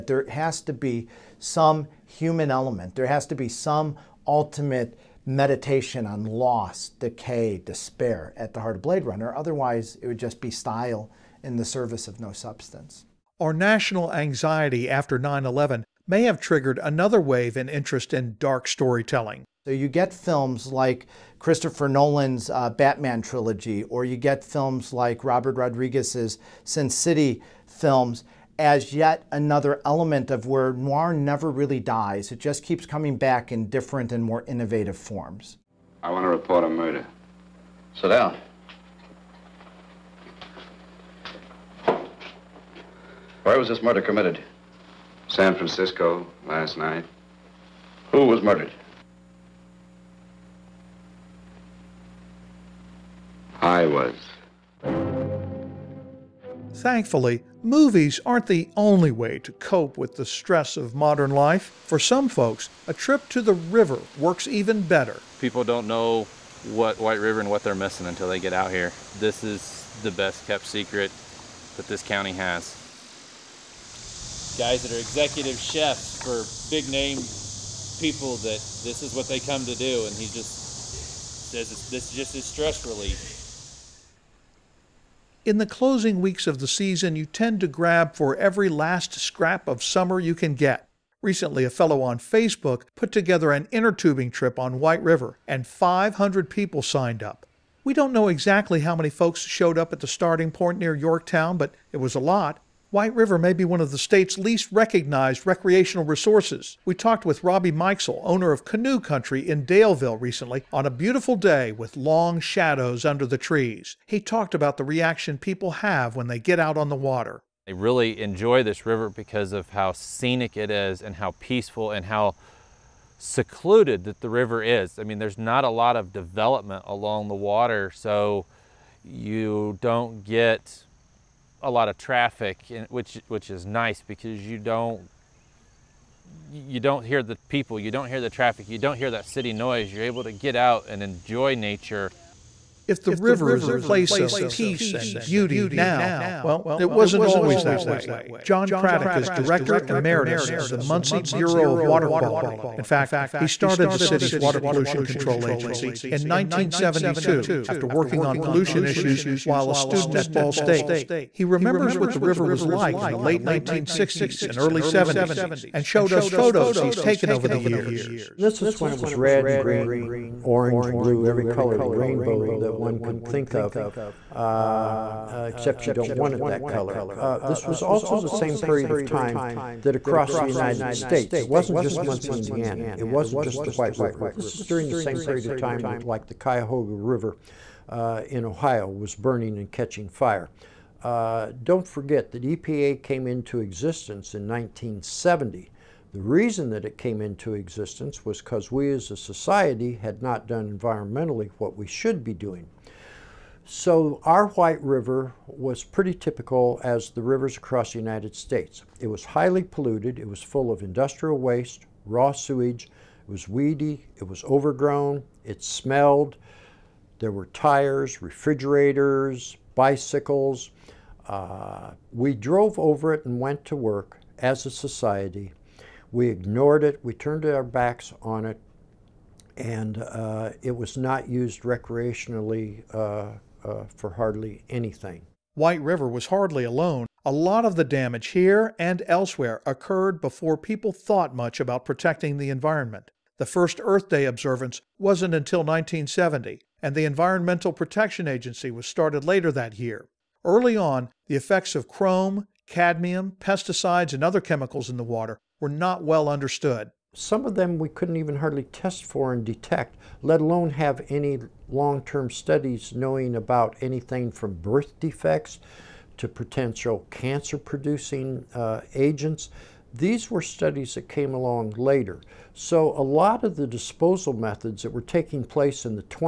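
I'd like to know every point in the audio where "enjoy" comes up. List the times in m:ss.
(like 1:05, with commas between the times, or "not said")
1:58, 2:21.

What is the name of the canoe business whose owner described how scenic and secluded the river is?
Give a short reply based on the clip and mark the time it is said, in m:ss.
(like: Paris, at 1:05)
Canoe Country, at 1:48.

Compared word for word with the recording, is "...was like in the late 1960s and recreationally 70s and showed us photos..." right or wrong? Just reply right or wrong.
wrong.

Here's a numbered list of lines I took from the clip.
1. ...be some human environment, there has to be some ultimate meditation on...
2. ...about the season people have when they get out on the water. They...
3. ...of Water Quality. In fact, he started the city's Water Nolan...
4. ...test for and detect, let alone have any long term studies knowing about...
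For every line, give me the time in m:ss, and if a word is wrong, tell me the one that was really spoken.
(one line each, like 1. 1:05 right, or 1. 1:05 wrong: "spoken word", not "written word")
1. 0:00 wrong: "element", not "environment"
2. 1:54 wrong: "reaction", not "season"
3. 2:31 wrong: "Pollution", not "Nolan"
4. 4:18 right.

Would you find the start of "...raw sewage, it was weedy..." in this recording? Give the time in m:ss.
3:32.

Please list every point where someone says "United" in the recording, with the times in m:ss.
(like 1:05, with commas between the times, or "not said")
3:00, 3:27.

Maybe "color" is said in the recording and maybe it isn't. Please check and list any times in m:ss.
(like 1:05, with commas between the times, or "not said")
2:51, 2:56.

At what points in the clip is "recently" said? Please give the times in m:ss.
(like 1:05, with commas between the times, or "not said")
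1:31, 1:50.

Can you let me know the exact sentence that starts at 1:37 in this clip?
We don't know exactly how many folks showed up at the starting point near Yorktown, but it was a lot.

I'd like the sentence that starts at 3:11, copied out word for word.
Uh, don't forget that EPA came into existence in 1970.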